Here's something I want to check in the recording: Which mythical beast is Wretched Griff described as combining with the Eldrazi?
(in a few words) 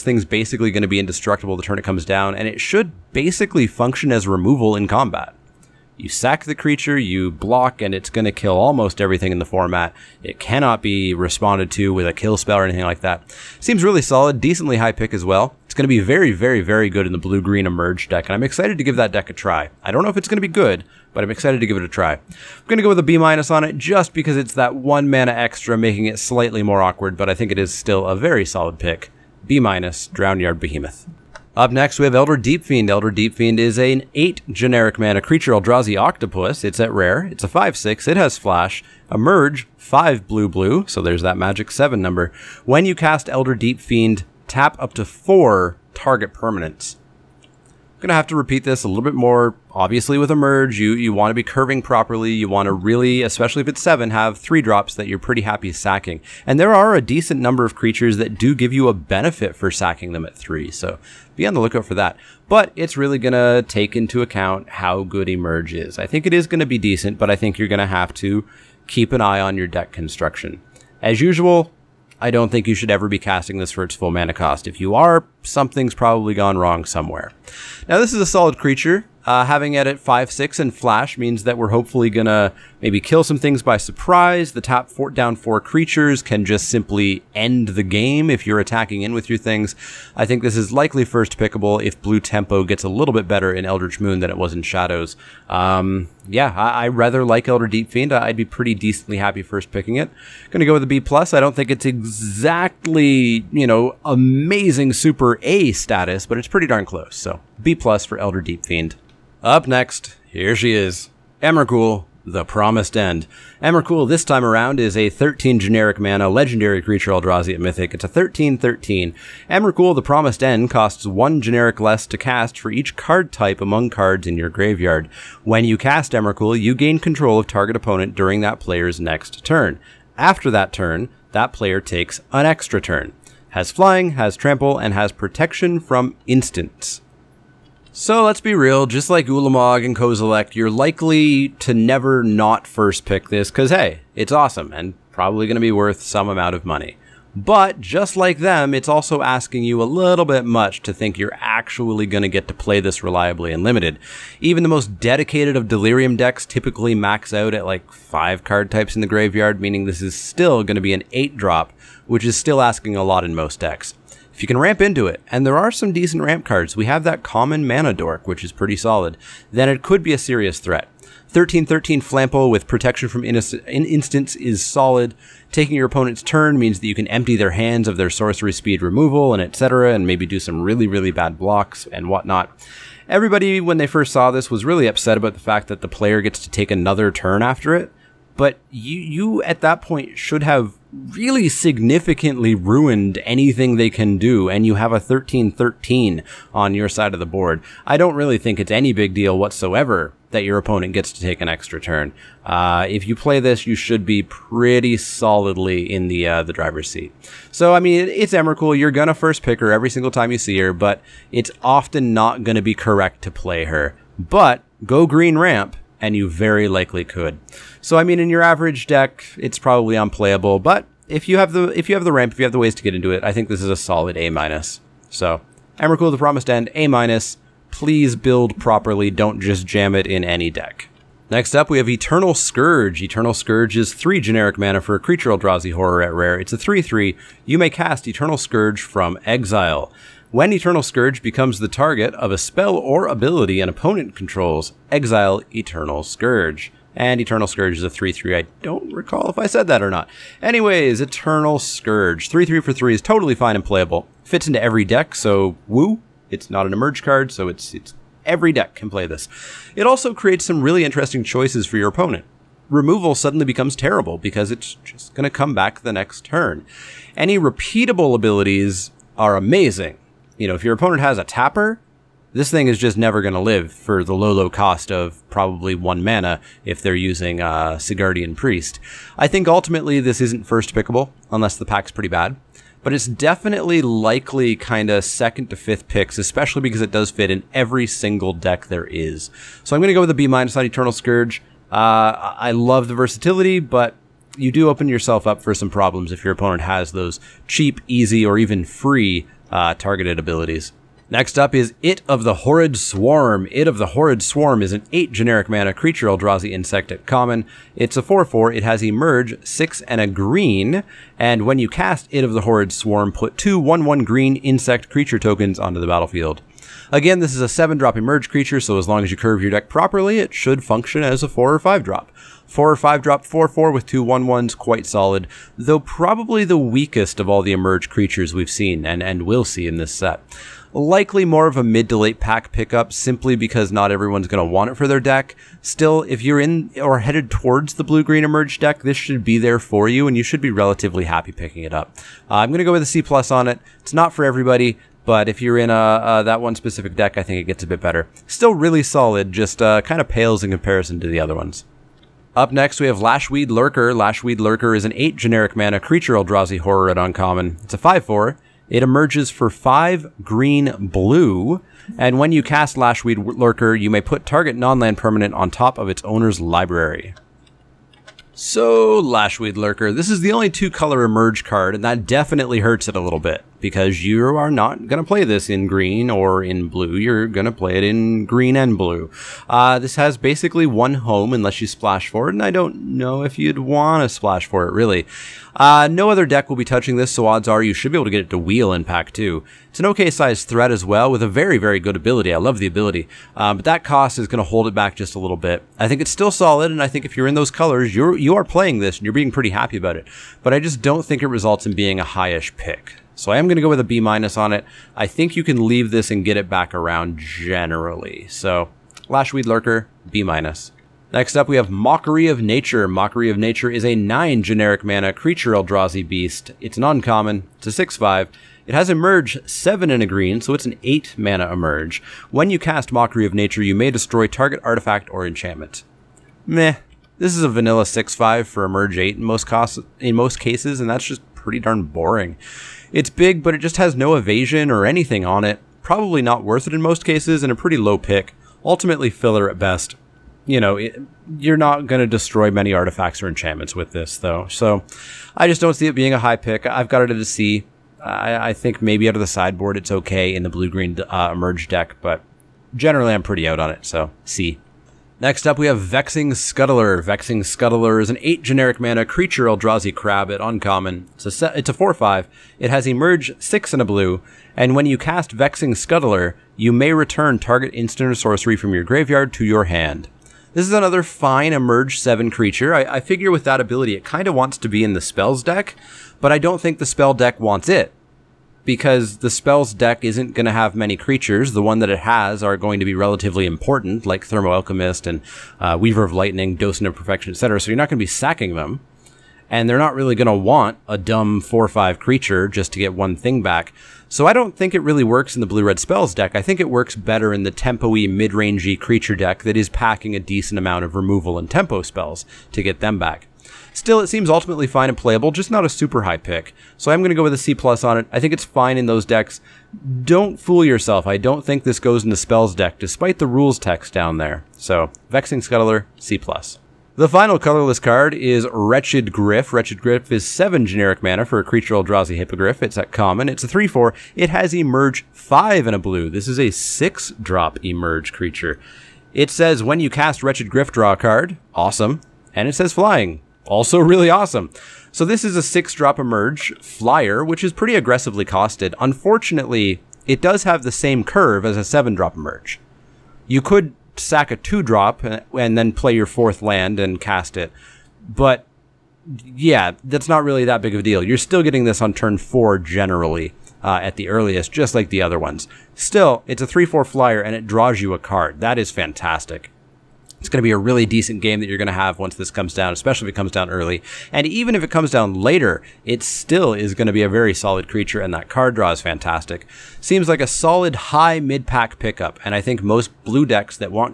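Hippogriff.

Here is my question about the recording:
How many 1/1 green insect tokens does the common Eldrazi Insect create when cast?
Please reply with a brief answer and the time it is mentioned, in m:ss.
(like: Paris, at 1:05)
2, at 5:13.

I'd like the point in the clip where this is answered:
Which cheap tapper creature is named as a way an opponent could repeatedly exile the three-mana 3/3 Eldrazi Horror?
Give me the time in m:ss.
4:37.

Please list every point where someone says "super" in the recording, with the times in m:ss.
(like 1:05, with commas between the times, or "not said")
1:44, 8:25.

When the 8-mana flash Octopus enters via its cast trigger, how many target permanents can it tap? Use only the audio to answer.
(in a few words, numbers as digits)
4.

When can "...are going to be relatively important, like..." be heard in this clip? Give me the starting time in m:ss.
8:02.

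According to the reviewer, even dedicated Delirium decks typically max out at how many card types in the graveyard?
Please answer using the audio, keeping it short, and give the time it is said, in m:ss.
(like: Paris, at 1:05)
5, at 2:37.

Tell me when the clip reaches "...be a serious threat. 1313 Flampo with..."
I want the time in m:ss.
2:50.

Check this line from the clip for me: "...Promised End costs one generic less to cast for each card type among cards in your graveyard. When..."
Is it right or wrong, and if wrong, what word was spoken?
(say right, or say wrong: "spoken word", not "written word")
right.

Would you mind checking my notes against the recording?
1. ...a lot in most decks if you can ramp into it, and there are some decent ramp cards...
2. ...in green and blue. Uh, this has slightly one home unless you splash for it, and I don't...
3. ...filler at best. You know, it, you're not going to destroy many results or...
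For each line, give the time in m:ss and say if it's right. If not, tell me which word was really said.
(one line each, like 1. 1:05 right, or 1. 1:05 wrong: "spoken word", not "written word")
1. 2:42 right
2. 6:17 wrong: "basically", not "slightly"
3. 7:19 wrong: "artifacts", not "results".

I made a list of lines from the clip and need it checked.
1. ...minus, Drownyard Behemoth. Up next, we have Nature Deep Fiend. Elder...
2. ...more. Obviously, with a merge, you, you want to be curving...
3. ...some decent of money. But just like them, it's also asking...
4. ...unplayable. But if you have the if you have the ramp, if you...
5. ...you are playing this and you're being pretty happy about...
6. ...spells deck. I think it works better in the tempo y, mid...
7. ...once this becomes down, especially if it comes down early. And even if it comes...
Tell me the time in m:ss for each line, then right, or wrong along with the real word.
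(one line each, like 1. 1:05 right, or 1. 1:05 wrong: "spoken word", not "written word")
1. 0:29 wrong: "Elder", not "Nature"
2. 0:49 right
3. 2:26 wrong: "amount", not "decent"
4. 3:39 right
5. 6:38 right
6. 8:15 right
7. 9:21 wrong: "comes", not "becomes".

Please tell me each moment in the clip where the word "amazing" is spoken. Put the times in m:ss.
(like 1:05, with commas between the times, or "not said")
1:44, 4:29.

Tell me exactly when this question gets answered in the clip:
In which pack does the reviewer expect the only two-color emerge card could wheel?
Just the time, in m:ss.
6:28.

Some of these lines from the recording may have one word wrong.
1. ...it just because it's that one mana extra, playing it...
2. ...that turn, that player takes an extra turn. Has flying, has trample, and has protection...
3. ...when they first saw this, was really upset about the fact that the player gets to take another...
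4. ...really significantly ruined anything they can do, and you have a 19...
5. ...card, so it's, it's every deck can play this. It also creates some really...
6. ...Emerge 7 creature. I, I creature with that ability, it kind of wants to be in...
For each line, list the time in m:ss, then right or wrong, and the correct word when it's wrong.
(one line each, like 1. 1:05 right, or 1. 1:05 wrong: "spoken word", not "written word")
1. 0:23 wrong: "making", not "playing"
2. 2:10 right
3. 3:03 right
4. 3:10 wrong: "13", not "19"
5. 4:17 right
6. 7:51 wrong: "figure", not "creature".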